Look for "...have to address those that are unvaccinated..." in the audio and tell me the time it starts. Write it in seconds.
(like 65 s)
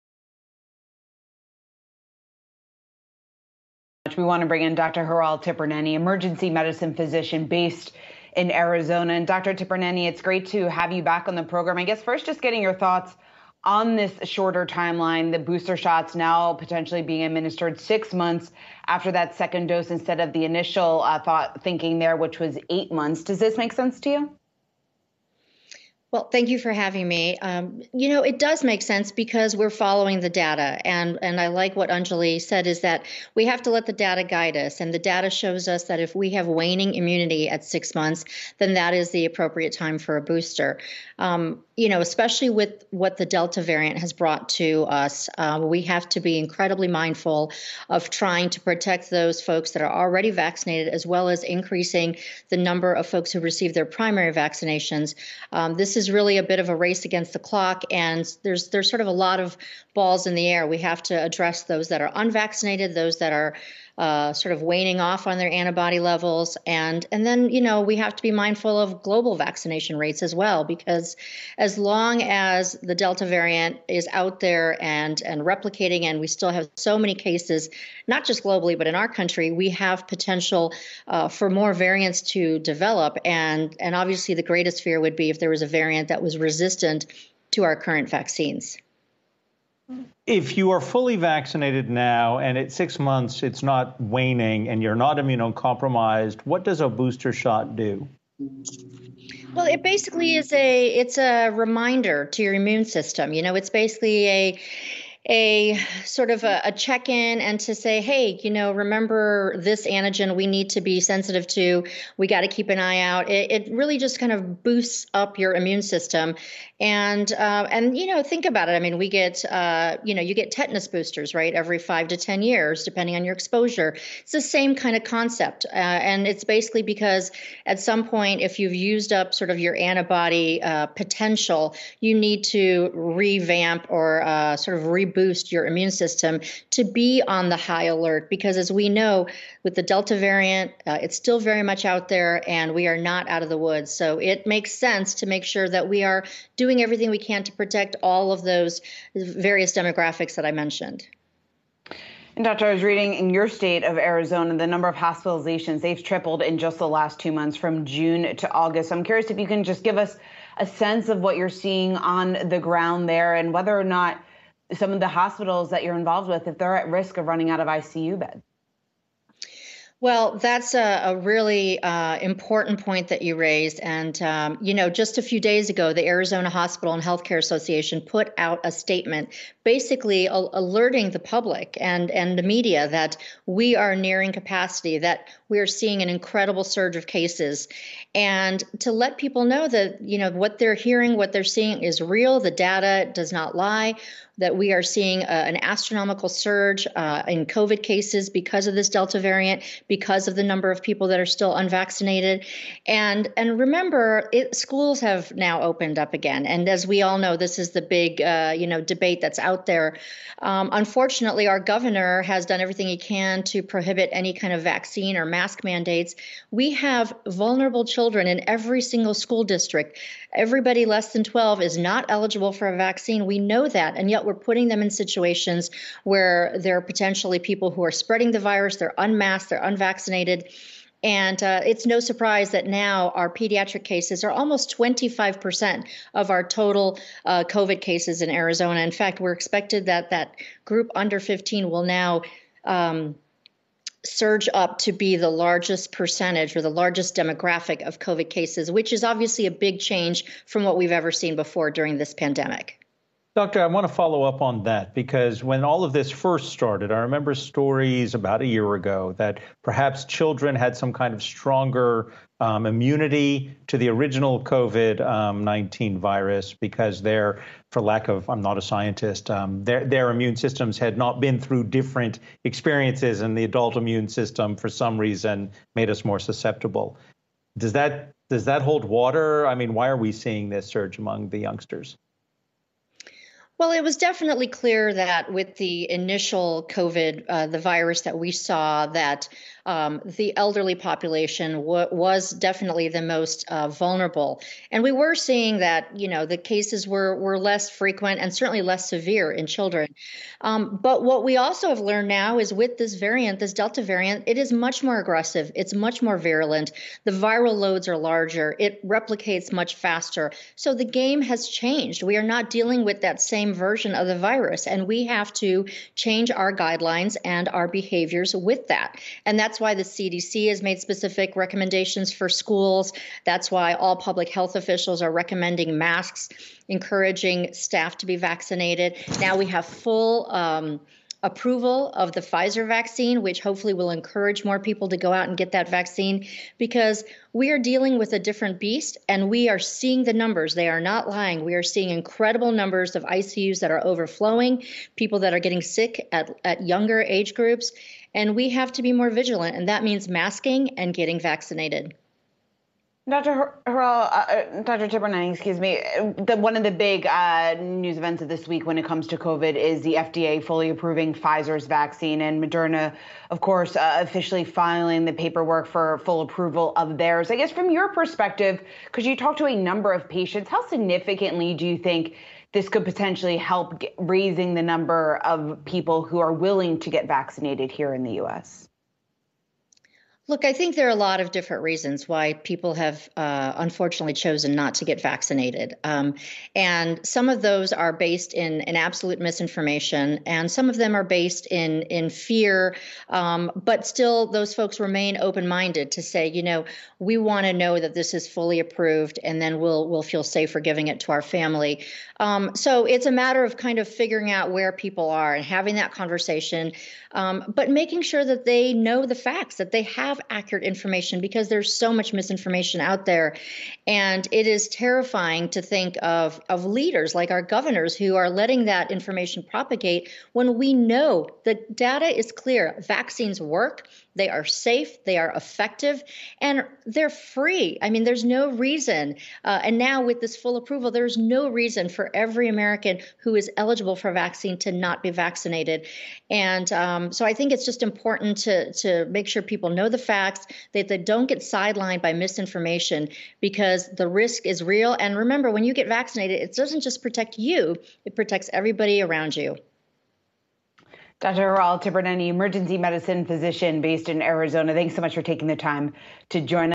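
60 s.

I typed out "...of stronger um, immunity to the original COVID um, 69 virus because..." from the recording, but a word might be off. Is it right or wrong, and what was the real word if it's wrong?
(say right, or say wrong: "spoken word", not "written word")
wrong: "19", not "69".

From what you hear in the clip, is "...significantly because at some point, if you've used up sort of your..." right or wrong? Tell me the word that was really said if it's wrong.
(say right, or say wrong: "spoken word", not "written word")
wrong: "basically", not "significantly".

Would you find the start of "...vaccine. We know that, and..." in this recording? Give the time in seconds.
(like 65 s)
222 s.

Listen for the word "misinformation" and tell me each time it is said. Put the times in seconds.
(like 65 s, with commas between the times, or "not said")
389 s, 412 s, 442 s.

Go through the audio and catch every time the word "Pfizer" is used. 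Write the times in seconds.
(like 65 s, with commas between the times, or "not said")
332 s, 361 s.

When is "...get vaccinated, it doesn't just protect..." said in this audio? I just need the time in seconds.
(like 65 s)
445 s.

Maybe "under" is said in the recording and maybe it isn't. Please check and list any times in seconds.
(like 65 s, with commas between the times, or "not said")
240 s.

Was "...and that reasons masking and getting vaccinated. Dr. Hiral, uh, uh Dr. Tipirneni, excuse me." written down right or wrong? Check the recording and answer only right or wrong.
wrong.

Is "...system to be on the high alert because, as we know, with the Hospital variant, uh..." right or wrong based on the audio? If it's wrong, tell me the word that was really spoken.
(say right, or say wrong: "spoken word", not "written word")
wrong: "Delta", not "Hospital".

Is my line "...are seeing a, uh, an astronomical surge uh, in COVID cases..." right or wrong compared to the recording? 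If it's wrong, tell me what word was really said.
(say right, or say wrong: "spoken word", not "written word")
right.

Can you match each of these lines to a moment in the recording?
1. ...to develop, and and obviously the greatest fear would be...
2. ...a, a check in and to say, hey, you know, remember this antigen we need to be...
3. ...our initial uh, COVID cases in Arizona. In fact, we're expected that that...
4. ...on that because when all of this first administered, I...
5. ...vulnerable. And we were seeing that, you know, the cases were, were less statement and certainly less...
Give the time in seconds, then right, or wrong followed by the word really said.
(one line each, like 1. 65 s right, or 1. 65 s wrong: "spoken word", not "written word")
1. 82 s right
2. 106 s right
3. 236 s wrong: "total", not "initial"
4. 254 s wrong: "started", not "administered"
5. 293 s wrong: "frequent", not "statement".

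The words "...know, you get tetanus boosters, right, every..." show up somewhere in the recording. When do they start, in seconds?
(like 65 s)
120 s.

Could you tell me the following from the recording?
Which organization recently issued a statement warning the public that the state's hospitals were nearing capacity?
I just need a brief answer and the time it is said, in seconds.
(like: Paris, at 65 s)
Arizona Hospital and Healthcare Association, at 176 s.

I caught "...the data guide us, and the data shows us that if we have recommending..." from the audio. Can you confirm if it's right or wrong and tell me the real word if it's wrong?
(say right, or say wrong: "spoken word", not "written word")
wrong: "waning", not "recommending".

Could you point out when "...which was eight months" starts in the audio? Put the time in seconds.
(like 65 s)
22 s.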